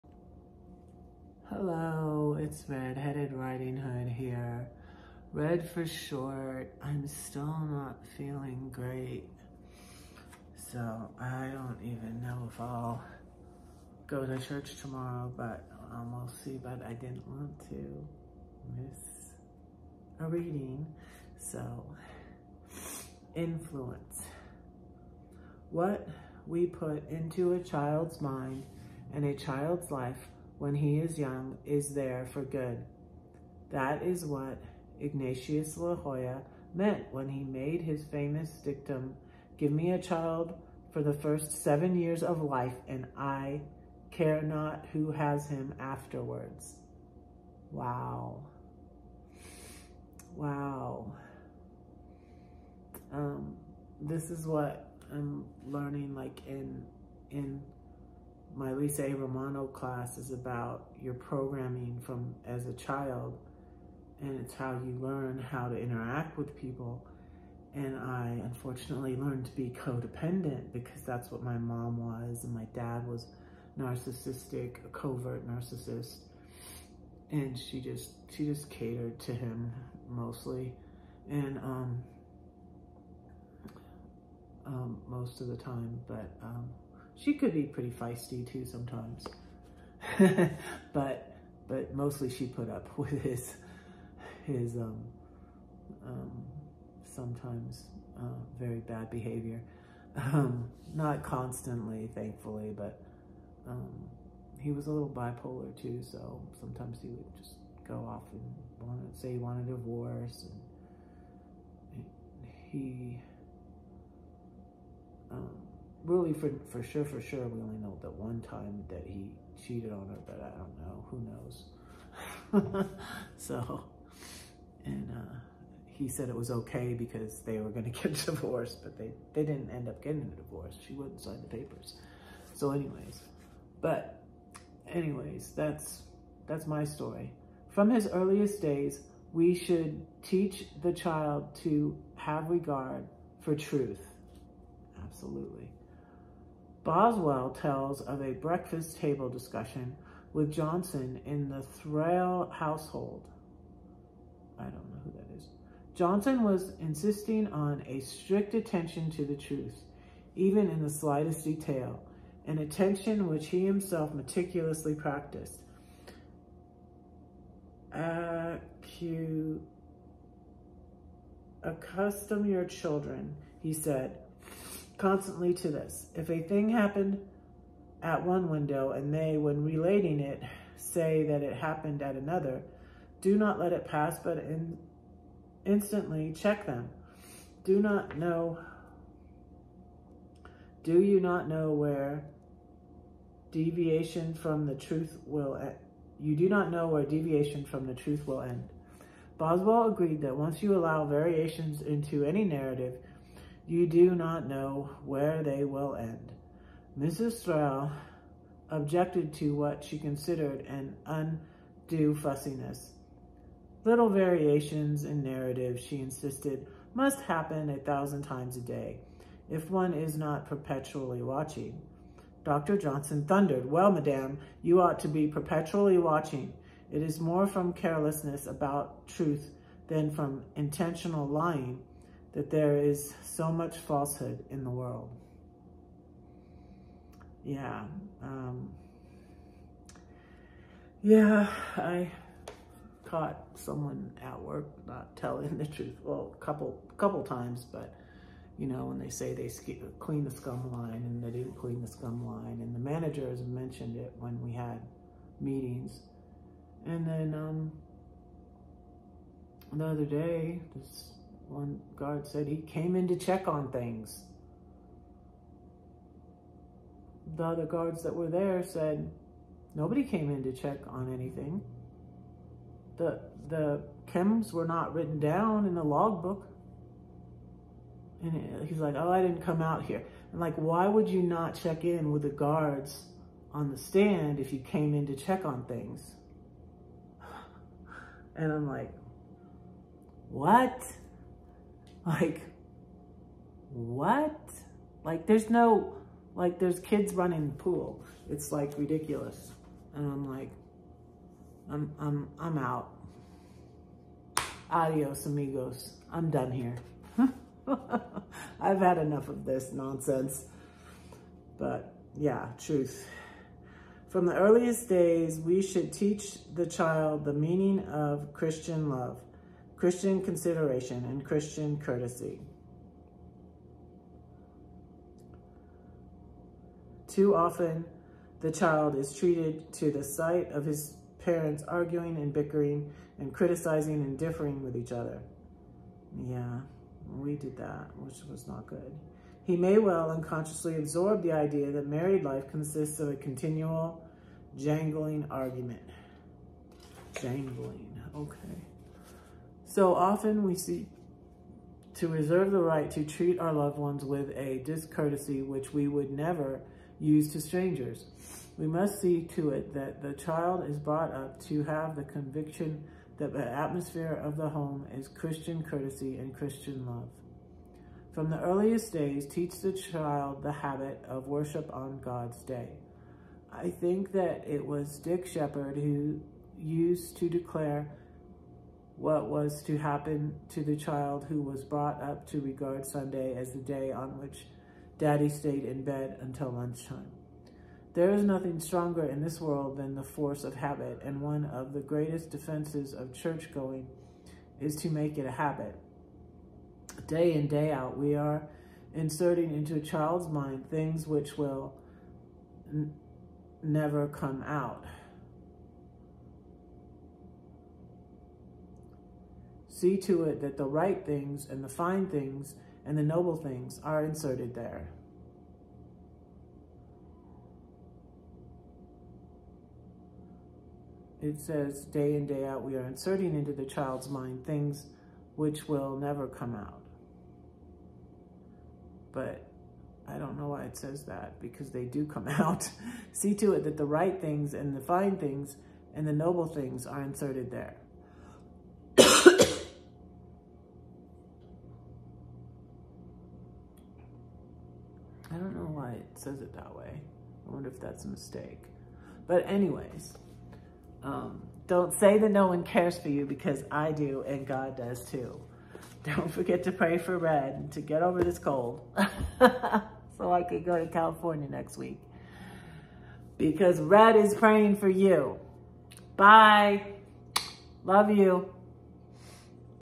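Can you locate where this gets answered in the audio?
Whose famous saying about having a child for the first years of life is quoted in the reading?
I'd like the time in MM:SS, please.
00:34.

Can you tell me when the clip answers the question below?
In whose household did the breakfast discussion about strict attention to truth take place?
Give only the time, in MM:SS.
02:31.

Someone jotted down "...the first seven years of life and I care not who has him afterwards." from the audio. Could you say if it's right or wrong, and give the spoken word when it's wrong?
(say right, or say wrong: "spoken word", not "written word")
right.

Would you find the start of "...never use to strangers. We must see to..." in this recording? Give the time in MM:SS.
05:56.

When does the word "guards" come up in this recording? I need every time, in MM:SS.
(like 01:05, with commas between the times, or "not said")
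04:21, 04:27, 04:42.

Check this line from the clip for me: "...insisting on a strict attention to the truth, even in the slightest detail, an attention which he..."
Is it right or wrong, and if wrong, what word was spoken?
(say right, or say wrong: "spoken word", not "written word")
right.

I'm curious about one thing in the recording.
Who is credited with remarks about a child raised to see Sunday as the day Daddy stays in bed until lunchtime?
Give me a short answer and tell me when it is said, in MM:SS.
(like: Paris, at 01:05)
Dick Sheppard, at 06:14.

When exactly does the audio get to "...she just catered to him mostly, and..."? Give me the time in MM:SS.
01:18.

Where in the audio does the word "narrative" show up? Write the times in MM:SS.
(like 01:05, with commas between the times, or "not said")
03:22, 03:35.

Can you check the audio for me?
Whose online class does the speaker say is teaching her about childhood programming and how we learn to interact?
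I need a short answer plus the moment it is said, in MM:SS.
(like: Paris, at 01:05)
Lisa A. Romano, at 00:58.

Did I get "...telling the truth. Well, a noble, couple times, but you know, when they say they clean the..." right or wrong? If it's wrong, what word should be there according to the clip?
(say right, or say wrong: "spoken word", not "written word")
wrong: "couple", not "noble".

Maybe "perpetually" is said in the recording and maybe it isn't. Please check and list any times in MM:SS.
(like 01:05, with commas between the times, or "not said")
03:40, 03:45.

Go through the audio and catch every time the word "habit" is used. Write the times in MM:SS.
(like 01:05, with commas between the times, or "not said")
06:10, 06:30, 06:35.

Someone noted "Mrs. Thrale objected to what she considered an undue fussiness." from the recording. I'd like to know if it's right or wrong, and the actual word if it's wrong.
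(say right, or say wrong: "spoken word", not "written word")
right.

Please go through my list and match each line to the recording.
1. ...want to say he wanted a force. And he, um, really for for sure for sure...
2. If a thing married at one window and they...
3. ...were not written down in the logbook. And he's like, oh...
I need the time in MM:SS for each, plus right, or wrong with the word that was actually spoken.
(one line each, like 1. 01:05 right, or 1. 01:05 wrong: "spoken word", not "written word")
1. 01:48 wrong: "divorce", not "force"
2. 02:56 wrong: "happened", not "married"
3. 04:34 right.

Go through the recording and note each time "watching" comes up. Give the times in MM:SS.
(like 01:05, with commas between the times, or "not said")
03:41, 03:45.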